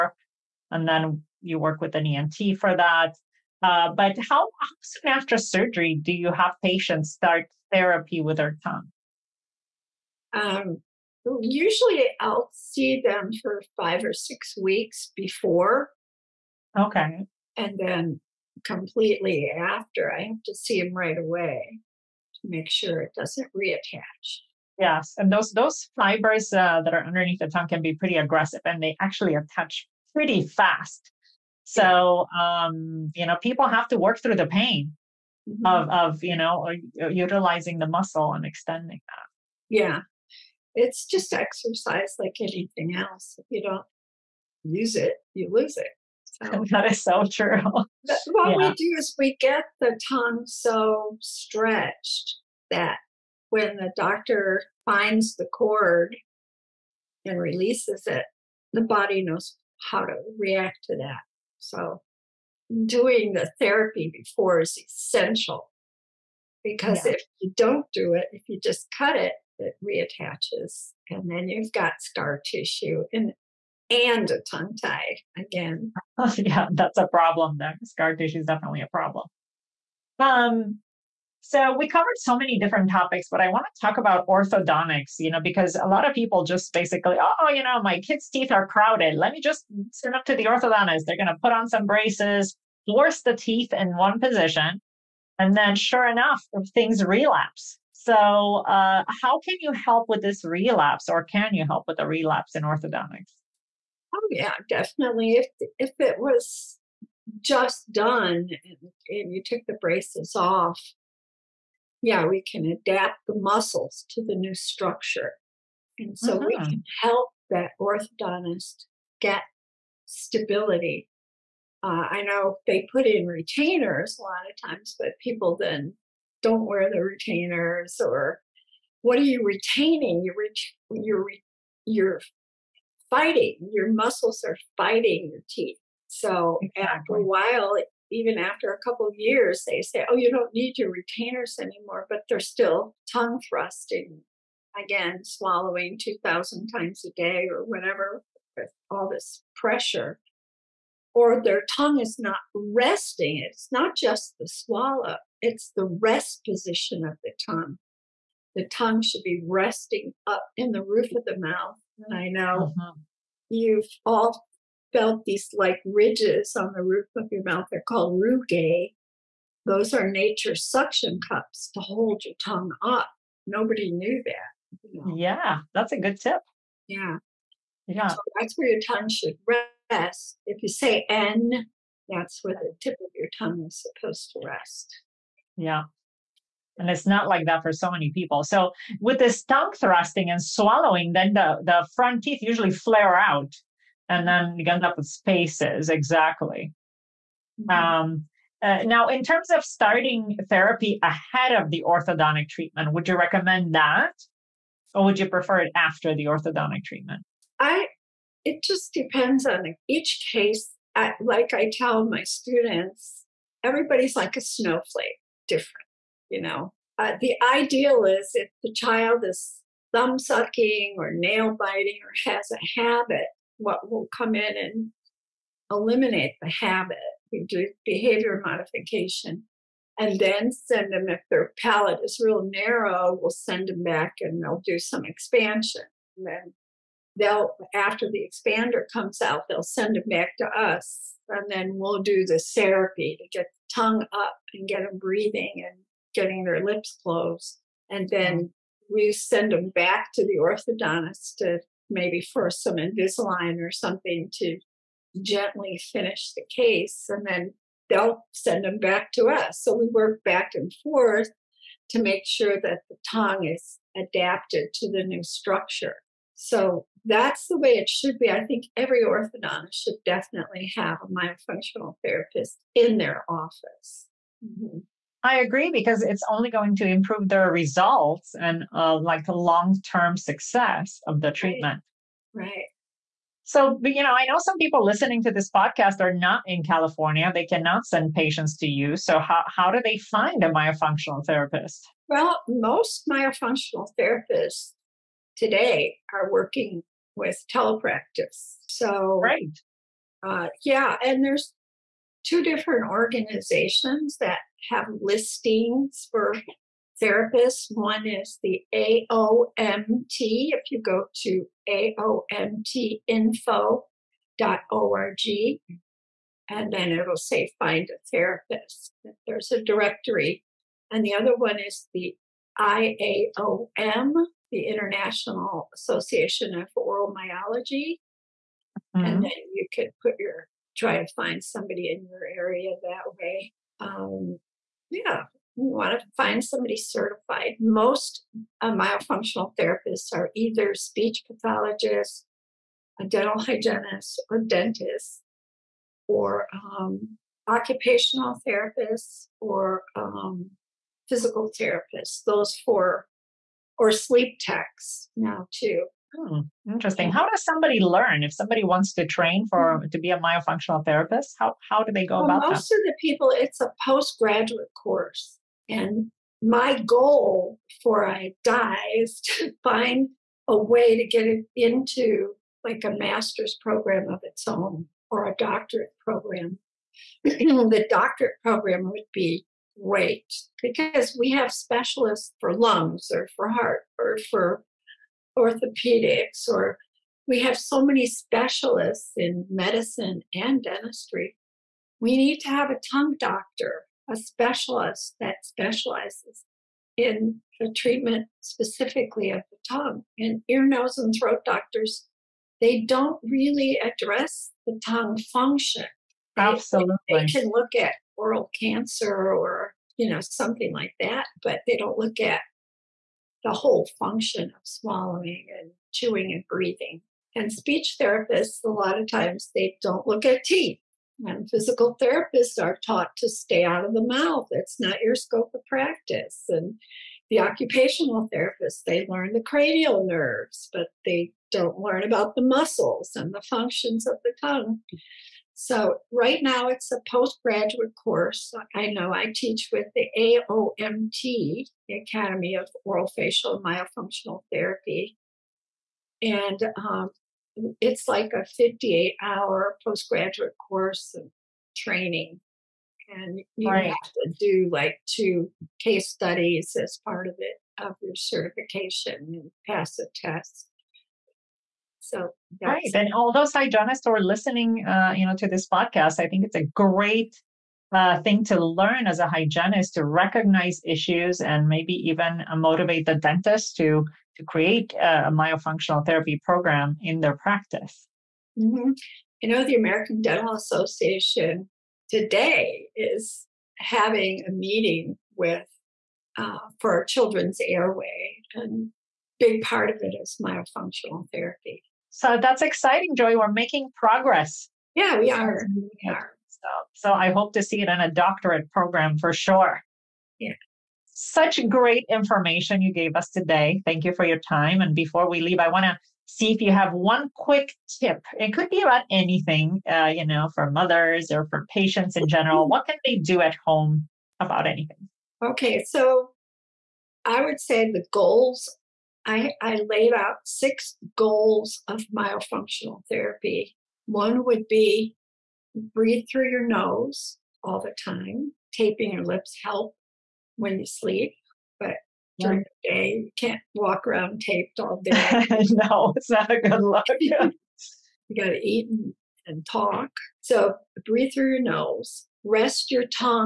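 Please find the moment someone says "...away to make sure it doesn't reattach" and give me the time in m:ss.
0:21.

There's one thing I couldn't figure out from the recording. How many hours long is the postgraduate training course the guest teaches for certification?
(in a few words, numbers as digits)
58 hours.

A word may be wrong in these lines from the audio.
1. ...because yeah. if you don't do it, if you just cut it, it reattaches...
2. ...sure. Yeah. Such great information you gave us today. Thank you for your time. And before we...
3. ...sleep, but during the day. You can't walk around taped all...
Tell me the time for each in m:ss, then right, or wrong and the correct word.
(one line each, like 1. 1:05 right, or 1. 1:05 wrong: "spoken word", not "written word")
1. 1:06 right
2. 8:19 right
3. 8:50 right.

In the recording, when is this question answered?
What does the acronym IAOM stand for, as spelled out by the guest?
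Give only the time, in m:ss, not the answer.
5:24.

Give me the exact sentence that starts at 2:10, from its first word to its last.
You're, ret- you're, re- you're fighting.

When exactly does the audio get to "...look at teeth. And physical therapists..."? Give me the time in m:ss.
7:00.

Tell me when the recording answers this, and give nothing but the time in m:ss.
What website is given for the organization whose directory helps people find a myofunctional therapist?
5:11.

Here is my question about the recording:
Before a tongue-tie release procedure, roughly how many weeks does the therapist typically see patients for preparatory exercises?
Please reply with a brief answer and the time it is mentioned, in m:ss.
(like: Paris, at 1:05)
5 or 6 weeks, at 0:13.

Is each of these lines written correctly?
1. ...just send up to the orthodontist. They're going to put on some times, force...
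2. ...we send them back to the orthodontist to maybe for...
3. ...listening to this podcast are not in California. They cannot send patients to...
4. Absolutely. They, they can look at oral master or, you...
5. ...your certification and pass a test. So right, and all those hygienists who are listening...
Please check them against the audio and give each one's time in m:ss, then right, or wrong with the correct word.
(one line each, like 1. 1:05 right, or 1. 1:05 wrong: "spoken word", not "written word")
1. 1:29 wrong: "braces", not "times"
2. 4:08 right
3. 4:44 right
4. 6:46 wrong: "cancer", not "master"
5. 7:38 right.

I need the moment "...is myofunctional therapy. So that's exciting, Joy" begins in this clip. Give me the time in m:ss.
8:10.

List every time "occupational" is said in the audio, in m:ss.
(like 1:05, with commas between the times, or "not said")
5:47, 7:07.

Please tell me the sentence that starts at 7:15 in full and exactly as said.
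So right now it's a postgraduate course.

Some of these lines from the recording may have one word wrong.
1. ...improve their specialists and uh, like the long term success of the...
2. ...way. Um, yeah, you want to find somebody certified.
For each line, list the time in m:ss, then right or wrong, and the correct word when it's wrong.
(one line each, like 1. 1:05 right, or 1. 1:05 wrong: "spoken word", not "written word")
1. 4:36 wrong: "results", not "specialists"
2. 5:33 right.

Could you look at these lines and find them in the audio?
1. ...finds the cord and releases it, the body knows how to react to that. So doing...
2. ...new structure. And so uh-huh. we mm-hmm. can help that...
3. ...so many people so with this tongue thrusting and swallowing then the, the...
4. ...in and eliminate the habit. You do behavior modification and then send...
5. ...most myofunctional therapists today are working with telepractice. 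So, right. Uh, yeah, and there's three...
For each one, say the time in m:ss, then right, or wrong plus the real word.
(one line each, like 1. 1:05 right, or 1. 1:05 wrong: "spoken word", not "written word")
1. 0:54 right
2. 1:54 right
3. 3:07 right
4. 3:44 right
5. 4:52 wrong: "two", not "three".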